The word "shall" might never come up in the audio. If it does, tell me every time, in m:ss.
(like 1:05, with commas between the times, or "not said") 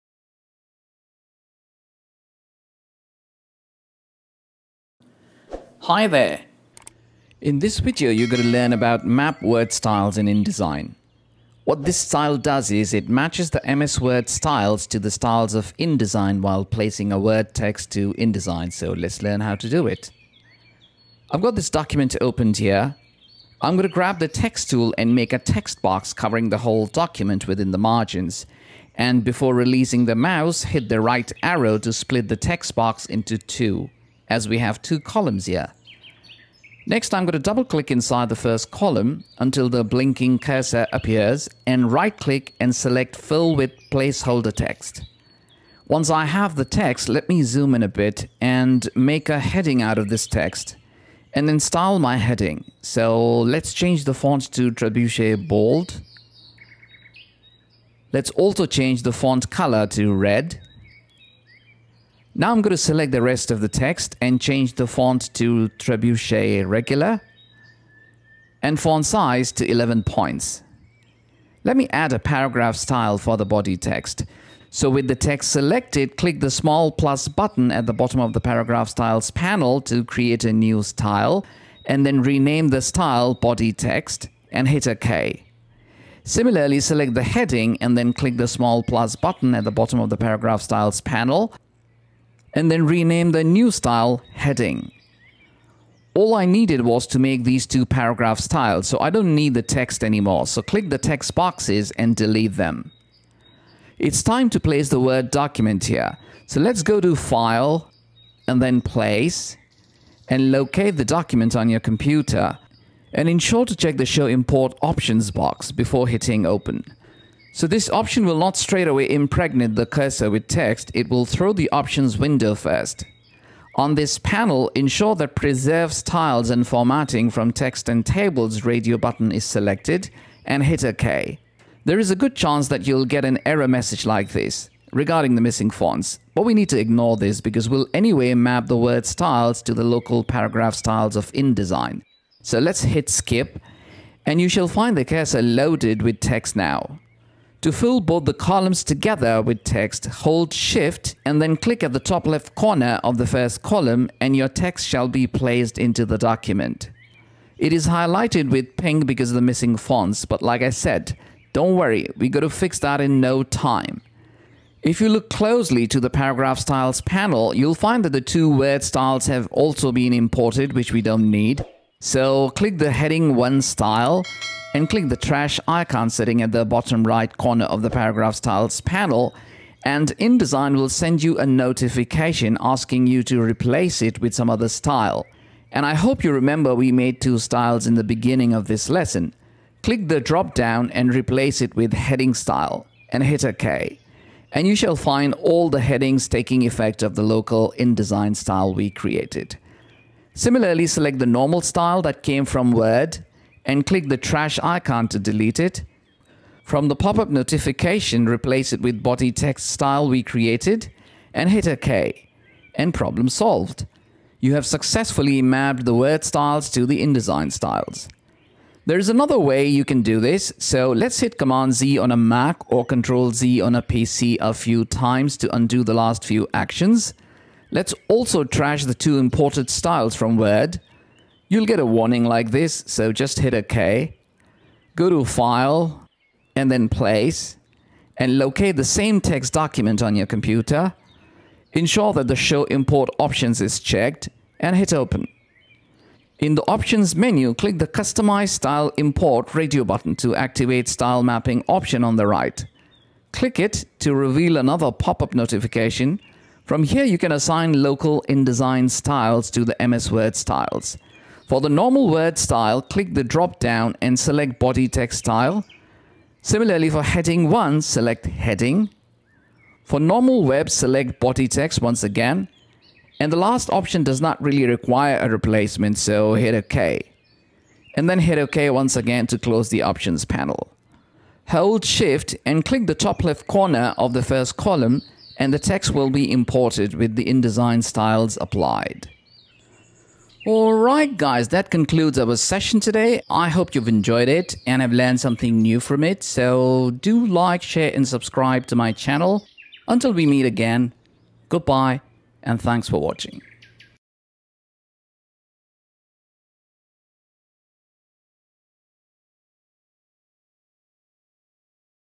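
2:24, 2:34, 3:14.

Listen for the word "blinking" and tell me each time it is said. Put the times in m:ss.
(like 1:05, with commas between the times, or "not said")
0:39.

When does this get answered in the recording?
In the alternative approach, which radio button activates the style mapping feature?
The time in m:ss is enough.
4:07.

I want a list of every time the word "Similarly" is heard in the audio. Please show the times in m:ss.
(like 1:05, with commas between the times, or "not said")
1:26, 3:20, 4:26.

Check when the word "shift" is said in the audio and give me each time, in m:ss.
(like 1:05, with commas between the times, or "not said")
2:30, 4:41.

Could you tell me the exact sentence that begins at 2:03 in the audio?
On this panel, ensure that Preserve Styles and Formatting from Text and Tables radio button is selected and hit OK.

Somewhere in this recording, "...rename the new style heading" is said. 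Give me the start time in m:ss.
1:32.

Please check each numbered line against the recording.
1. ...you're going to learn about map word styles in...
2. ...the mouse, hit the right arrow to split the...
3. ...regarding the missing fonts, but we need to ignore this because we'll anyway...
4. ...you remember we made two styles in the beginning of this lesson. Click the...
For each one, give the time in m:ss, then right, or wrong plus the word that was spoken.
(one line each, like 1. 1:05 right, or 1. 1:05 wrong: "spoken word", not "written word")
1. 0:08 right
2. 0:30 right
3. 2:14 right
4. 3:06 right.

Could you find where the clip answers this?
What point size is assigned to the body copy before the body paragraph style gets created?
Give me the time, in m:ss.
1:09.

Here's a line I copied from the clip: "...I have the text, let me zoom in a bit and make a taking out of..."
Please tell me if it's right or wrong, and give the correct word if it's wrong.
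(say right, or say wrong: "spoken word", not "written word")
wrong: "heading", not "taking".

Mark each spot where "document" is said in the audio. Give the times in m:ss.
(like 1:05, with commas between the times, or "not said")
0:21, 0:26, 1:45, 1:51, 2:36, 3:59.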